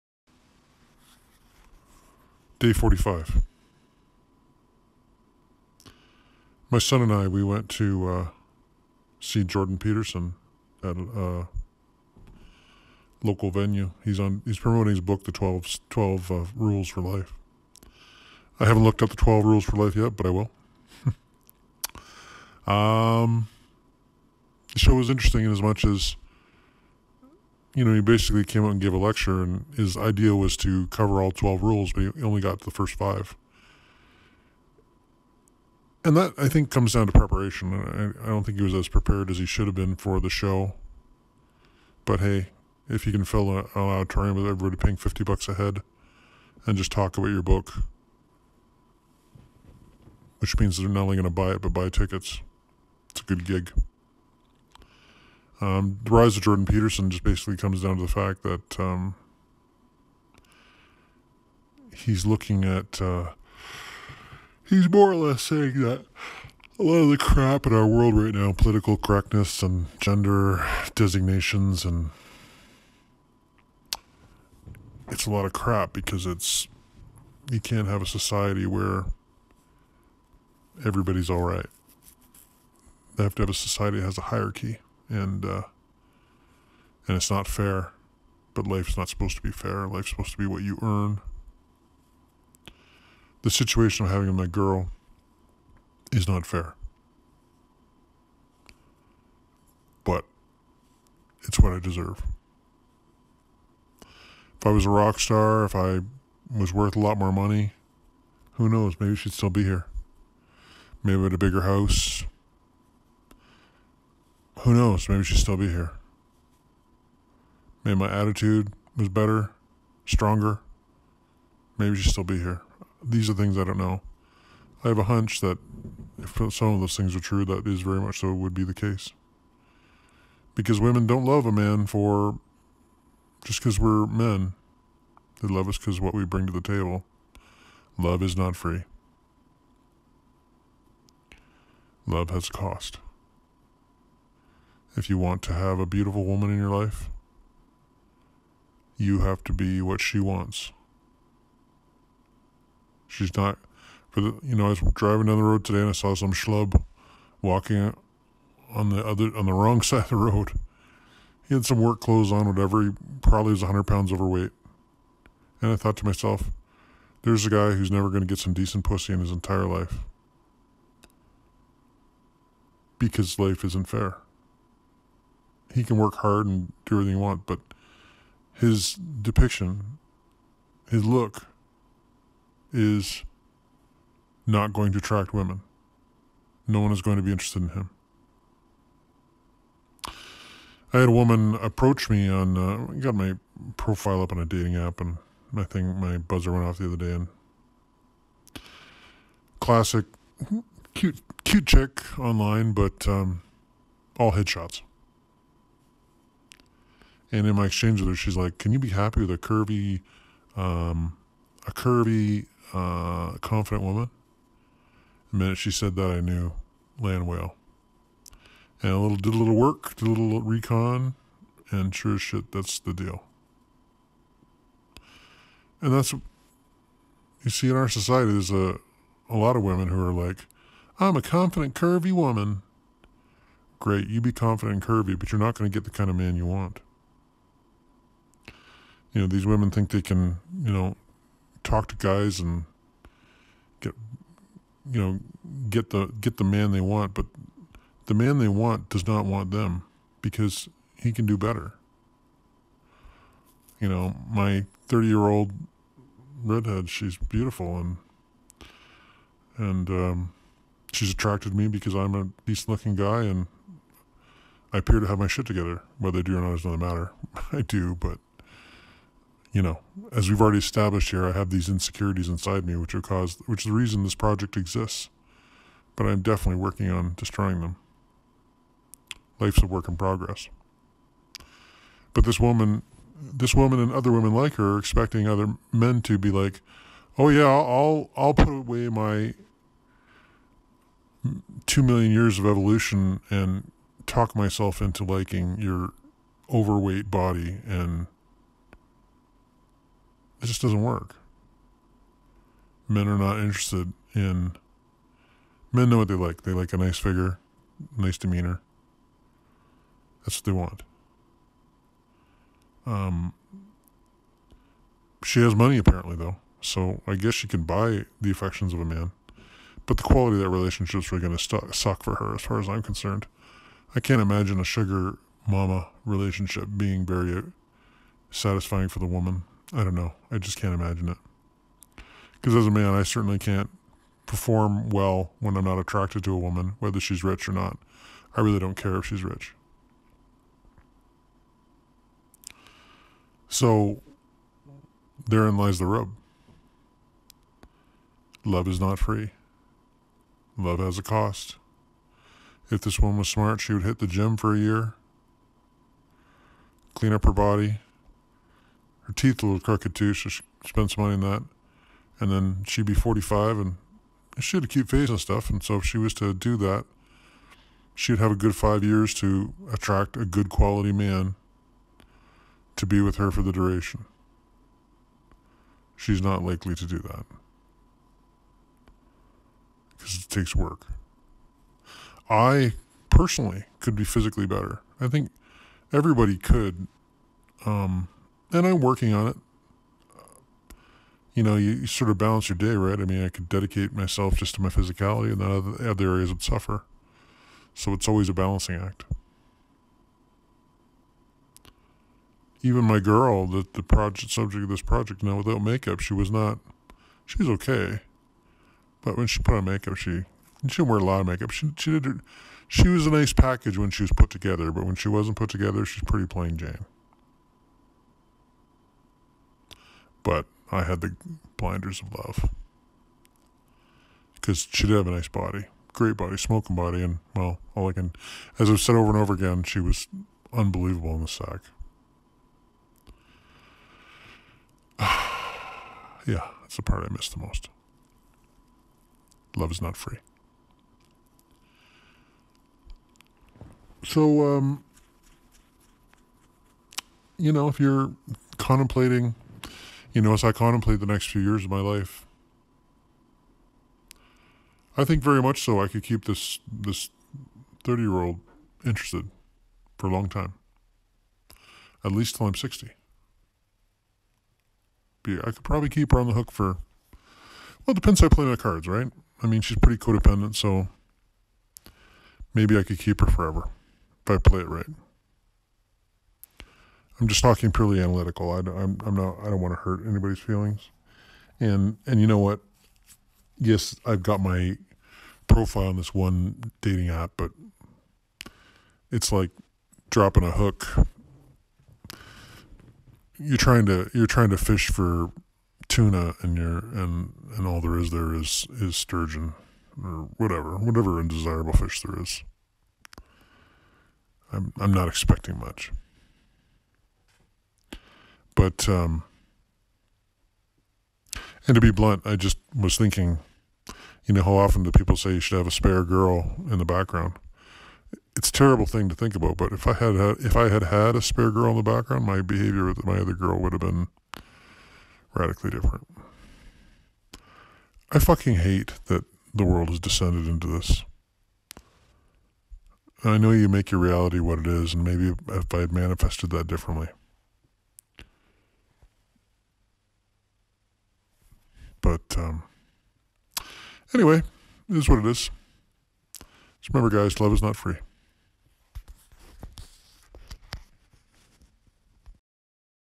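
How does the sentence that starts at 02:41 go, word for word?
He had some work clothes on, whatever.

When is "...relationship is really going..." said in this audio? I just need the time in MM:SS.
05:20.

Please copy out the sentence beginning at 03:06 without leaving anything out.
No one is going to be interested in him.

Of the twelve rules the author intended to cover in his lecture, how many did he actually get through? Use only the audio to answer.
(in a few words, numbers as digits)
5.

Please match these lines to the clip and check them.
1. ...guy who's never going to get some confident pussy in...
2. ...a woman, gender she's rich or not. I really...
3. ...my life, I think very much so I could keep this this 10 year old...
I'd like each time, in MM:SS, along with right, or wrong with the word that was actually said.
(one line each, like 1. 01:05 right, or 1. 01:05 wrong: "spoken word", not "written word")
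1. 02:47 wrong: "decent", not "confident"
2. 05:36 wrong: "whether", not "gender"
3. 07:31 wrong: "30", not "10".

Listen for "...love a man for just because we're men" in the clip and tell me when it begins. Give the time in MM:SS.
02:11.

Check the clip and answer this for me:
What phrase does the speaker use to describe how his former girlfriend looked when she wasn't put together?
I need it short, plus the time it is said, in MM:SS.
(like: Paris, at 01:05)
plain Jane, at 06:56.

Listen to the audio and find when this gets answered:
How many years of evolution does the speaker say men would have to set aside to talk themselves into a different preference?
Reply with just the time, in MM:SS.
04:51.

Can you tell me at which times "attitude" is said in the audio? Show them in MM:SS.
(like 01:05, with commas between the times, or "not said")
01:58.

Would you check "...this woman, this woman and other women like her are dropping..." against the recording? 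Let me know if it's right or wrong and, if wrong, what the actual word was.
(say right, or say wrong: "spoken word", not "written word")
wrong: "expecting", not "dropping".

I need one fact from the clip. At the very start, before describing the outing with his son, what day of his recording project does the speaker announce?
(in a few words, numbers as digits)
Day 45.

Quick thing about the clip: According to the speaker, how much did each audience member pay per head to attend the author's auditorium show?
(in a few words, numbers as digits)
$50.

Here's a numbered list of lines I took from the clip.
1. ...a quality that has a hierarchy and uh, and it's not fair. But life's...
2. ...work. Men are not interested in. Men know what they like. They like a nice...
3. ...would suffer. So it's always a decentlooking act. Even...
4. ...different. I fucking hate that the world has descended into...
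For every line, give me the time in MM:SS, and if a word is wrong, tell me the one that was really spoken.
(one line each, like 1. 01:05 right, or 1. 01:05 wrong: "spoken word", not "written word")
1. 01:23 wrong: "society", not "quality"
2. 05:00 right
3. 06:36 wrong: "balancing", not "decentlooking"
4. 08:45 right.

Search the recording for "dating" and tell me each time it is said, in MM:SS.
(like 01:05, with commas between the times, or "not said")
03:14, 08:06.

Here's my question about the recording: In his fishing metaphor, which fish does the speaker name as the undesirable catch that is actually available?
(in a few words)
sturgeon.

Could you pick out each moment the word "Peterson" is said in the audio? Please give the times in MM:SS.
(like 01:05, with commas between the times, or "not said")
00:09, 00:56.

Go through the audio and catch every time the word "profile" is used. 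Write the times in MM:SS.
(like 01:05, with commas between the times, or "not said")
03:13, 08:05.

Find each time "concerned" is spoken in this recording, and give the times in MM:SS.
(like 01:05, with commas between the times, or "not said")
05:22.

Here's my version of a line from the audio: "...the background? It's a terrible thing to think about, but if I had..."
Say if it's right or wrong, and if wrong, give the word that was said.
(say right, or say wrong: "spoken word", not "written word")
right.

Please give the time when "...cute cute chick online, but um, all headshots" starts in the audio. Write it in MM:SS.
03:20.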